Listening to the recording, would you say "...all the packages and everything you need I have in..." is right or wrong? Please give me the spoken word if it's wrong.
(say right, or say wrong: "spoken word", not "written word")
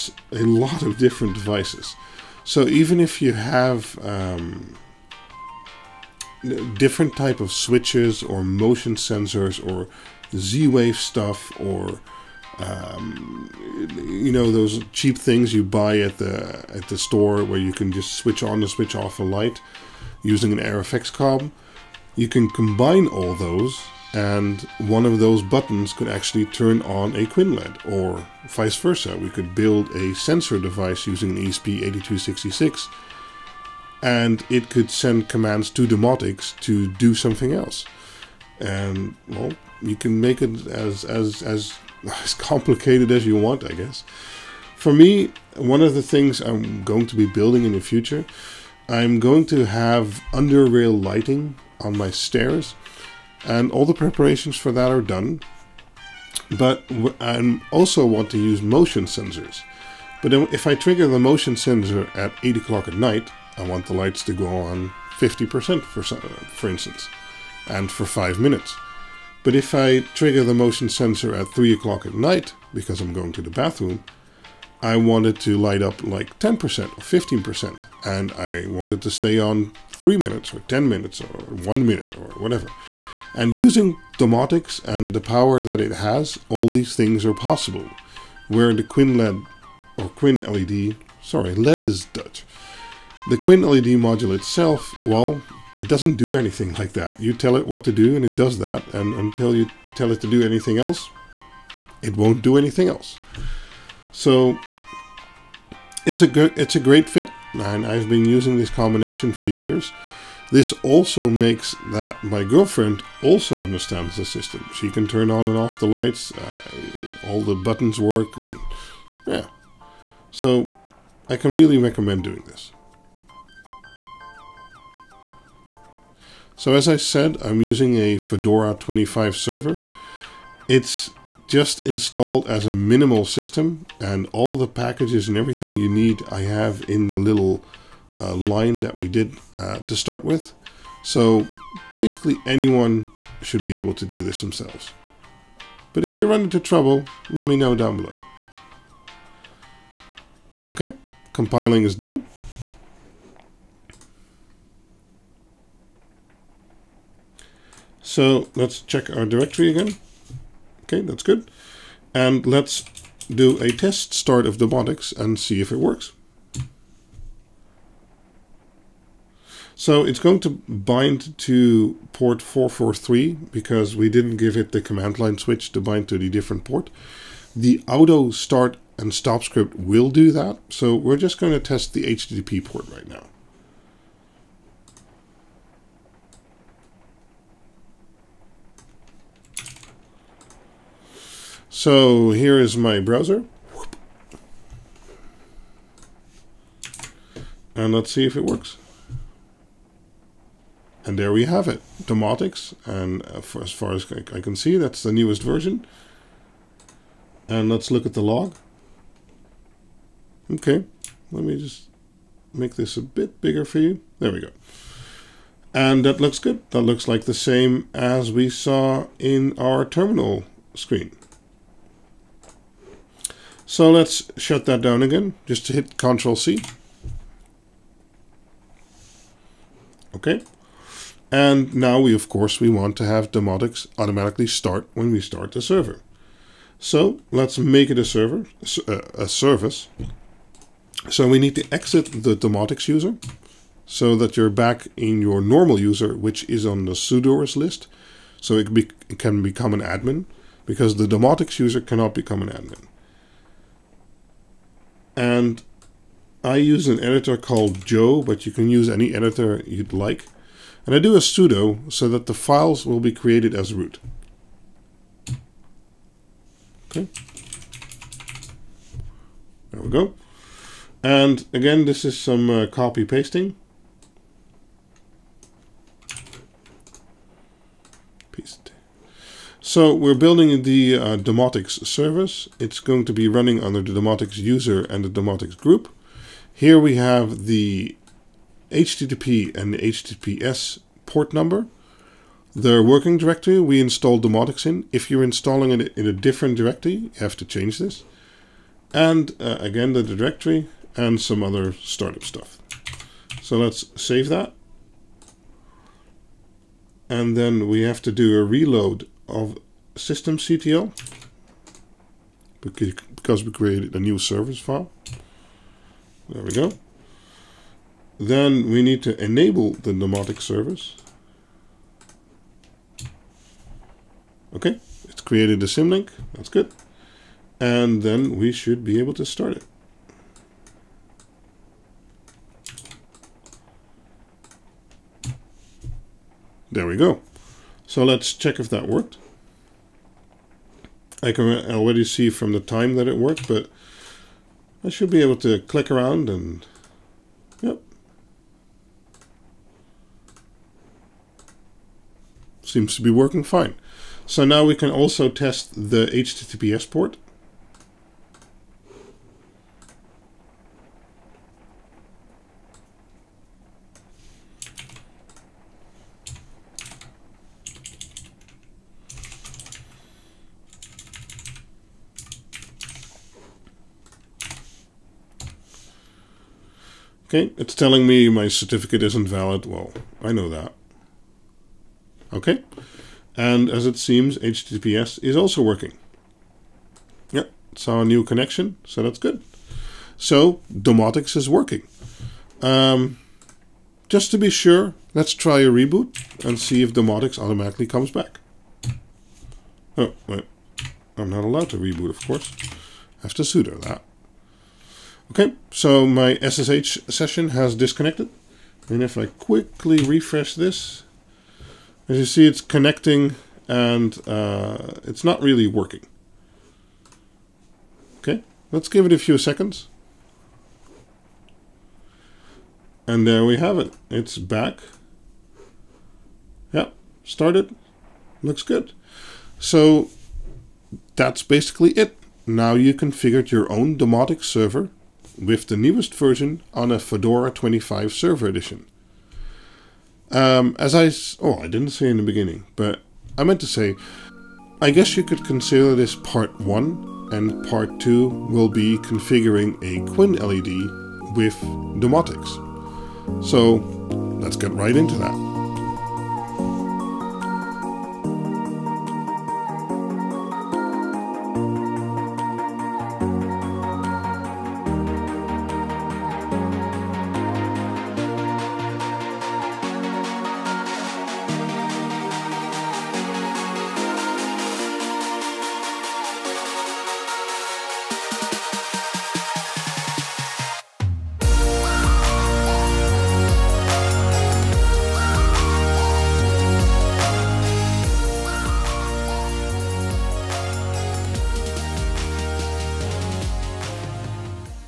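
right.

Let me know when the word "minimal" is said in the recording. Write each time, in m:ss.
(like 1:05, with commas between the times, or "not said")
2:12.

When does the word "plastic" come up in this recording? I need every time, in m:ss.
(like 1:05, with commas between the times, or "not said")
not said.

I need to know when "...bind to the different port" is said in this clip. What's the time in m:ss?
2:55.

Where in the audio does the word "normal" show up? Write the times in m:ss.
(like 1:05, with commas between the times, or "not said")
4:05.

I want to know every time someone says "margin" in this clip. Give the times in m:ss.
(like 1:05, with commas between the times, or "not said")
not said.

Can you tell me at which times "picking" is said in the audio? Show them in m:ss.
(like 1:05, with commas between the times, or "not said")
not said.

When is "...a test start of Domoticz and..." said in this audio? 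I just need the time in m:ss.
2:43.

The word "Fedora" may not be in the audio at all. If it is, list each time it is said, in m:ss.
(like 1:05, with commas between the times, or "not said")
2:08, 7:16.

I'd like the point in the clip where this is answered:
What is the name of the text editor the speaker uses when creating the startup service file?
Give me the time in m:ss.
4:17.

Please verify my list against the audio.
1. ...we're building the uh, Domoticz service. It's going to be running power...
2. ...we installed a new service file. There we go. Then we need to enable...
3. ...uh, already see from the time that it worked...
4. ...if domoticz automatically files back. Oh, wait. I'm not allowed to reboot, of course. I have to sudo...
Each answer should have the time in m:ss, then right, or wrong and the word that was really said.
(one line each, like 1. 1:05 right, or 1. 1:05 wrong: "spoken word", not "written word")
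1. 4:39 wrong: "under", not "power"
2. 5:13 wrong: "created", not "installed"
3. 5:41 right
4. 6:36 wrong: "comes", not "files".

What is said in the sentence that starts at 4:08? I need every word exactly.
So it, be, it can become an admin because the Domoticz user cannot become an admin.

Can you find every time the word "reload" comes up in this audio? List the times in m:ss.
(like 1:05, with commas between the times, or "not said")
5:08.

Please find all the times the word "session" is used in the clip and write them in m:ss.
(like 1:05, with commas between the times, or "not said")
6:47.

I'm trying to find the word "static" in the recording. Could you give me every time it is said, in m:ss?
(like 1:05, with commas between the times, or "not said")
not said.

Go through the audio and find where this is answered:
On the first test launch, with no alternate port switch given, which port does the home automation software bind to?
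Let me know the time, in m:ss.
2:52.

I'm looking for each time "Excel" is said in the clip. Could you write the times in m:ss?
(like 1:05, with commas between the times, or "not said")
not said.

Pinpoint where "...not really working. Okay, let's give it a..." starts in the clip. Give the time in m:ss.
6:55.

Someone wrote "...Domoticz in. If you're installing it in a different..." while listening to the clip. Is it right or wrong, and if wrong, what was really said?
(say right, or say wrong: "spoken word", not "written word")
right.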